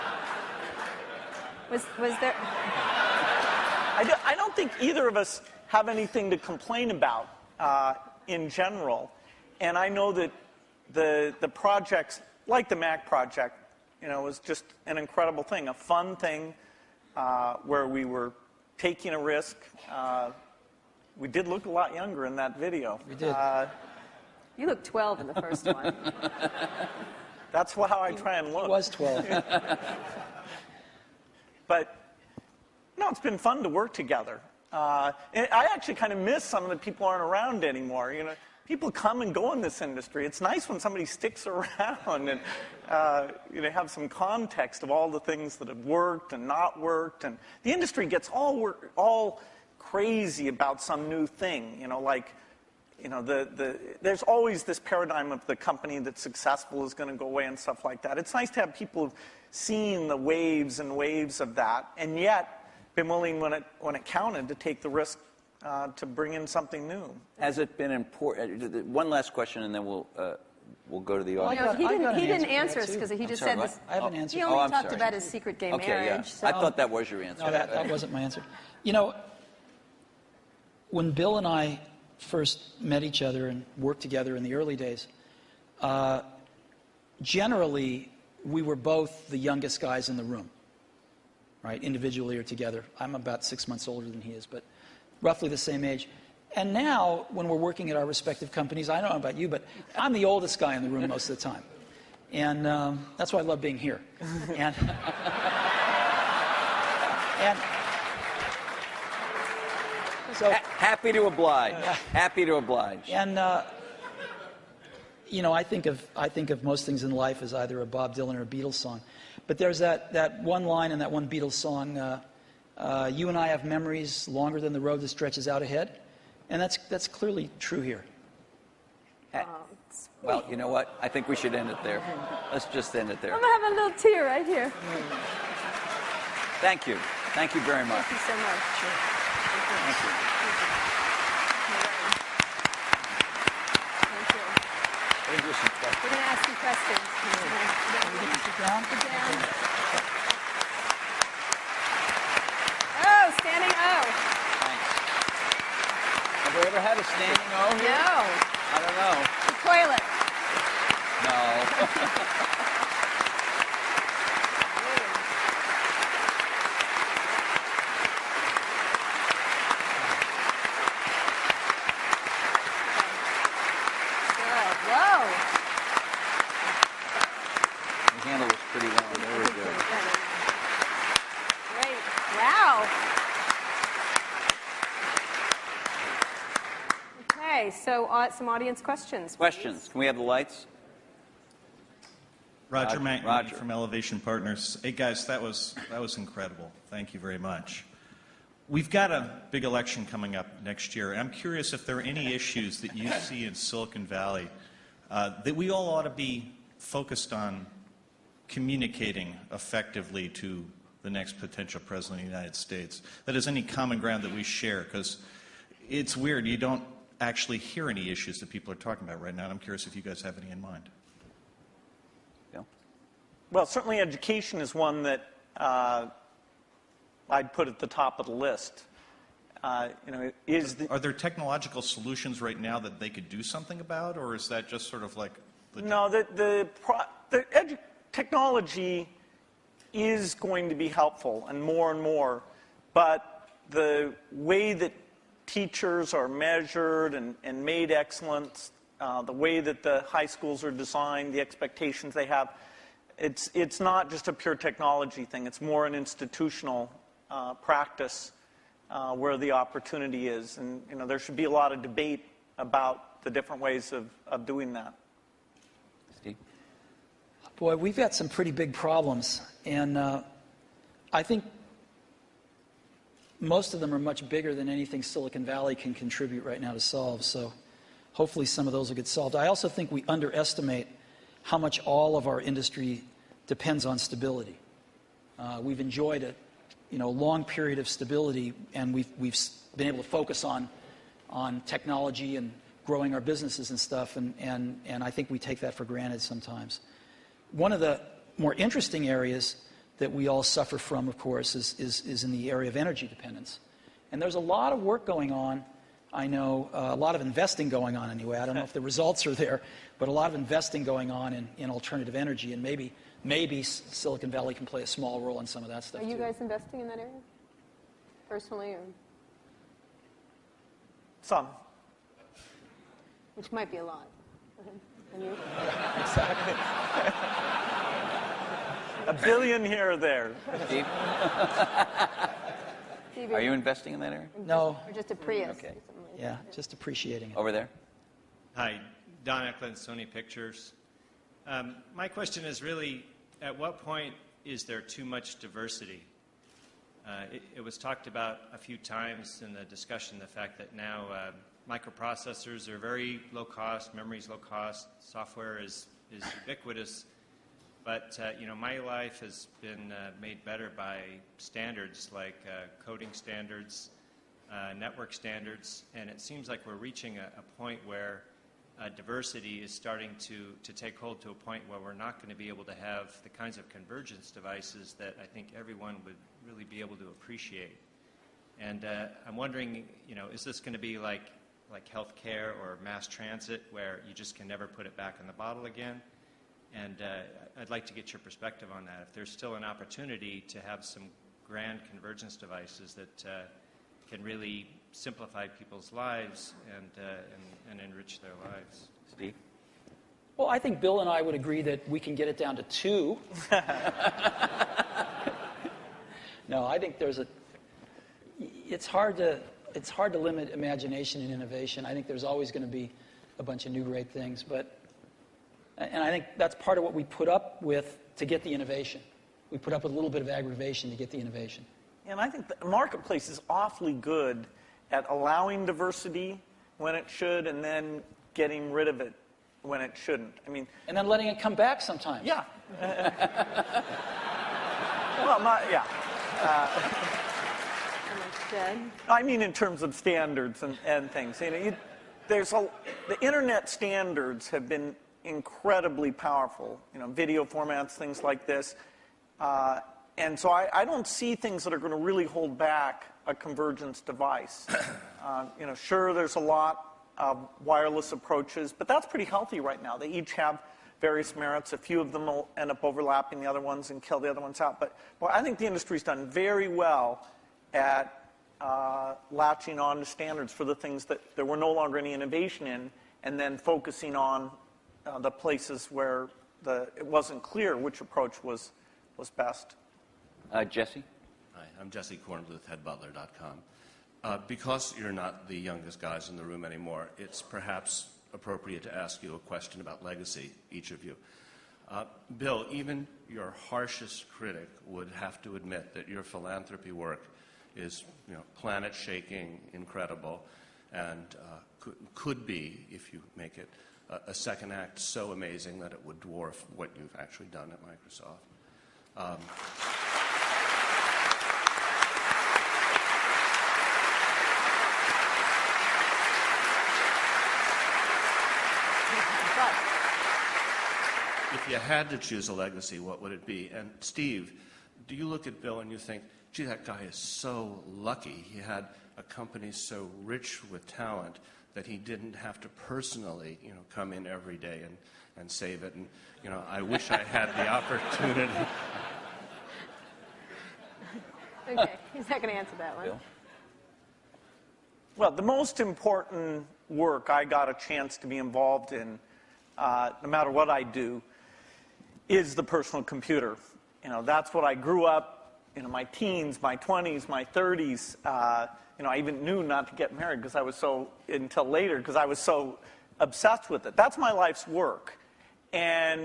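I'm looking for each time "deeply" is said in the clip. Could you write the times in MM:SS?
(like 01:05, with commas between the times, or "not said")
not said.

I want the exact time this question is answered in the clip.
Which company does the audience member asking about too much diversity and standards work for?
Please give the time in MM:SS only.
05:39.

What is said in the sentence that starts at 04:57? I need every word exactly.
One of the more interesting areas that we all suffer from, of course, is, is, is in the area of energy dependence.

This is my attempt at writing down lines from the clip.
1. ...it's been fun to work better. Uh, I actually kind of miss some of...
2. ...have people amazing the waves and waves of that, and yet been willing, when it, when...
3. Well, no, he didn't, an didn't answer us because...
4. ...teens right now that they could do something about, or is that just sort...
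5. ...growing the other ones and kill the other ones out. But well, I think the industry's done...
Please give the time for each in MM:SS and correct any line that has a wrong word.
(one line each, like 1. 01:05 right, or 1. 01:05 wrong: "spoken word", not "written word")
1. 00:33 wrong: "together", not "better"
2. 00:58 wrong: "seeing", not "amazing"
3. 01:11 right
4. 03:51 wrong: "solutions", not "teens"
5. 07:42 wrong: "overlapping", not "growing".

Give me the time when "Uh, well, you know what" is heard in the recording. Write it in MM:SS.
02:09.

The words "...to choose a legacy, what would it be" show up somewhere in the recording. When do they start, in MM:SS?
08:42.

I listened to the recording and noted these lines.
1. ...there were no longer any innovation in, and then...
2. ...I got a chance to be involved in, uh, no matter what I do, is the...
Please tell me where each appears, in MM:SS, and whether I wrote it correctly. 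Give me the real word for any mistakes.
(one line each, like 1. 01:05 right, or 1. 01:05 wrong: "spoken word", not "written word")
1. 07:51 right
2. 09:07 right.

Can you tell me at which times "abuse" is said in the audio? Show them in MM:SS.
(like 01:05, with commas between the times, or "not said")
not said.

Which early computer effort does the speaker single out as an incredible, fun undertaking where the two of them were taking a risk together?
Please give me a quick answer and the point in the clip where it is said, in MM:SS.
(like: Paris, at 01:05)
Mac project, at 00:12.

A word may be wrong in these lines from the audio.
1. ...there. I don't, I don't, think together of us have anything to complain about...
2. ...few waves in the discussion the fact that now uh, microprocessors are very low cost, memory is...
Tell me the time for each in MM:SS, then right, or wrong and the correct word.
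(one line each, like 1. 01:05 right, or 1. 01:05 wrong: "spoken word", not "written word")
1. 00:02 wrong: "either", not "together"
2. 05:48 wrong: "times", not "waves".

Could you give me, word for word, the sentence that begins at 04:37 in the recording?
So hopefully some of those will get solved.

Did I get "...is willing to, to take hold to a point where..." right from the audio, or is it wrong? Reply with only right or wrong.
wrong.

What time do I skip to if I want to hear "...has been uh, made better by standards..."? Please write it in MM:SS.
05:59.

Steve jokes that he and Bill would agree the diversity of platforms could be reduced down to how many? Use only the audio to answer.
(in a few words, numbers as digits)
2.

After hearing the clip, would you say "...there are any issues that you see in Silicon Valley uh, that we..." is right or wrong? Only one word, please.
right.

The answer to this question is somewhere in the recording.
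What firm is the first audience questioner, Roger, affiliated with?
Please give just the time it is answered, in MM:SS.
03:13.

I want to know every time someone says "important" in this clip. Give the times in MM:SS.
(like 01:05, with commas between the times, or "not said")
01:07, 09:05.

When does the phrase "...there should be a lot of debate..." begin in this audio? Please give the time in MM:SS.
04:21.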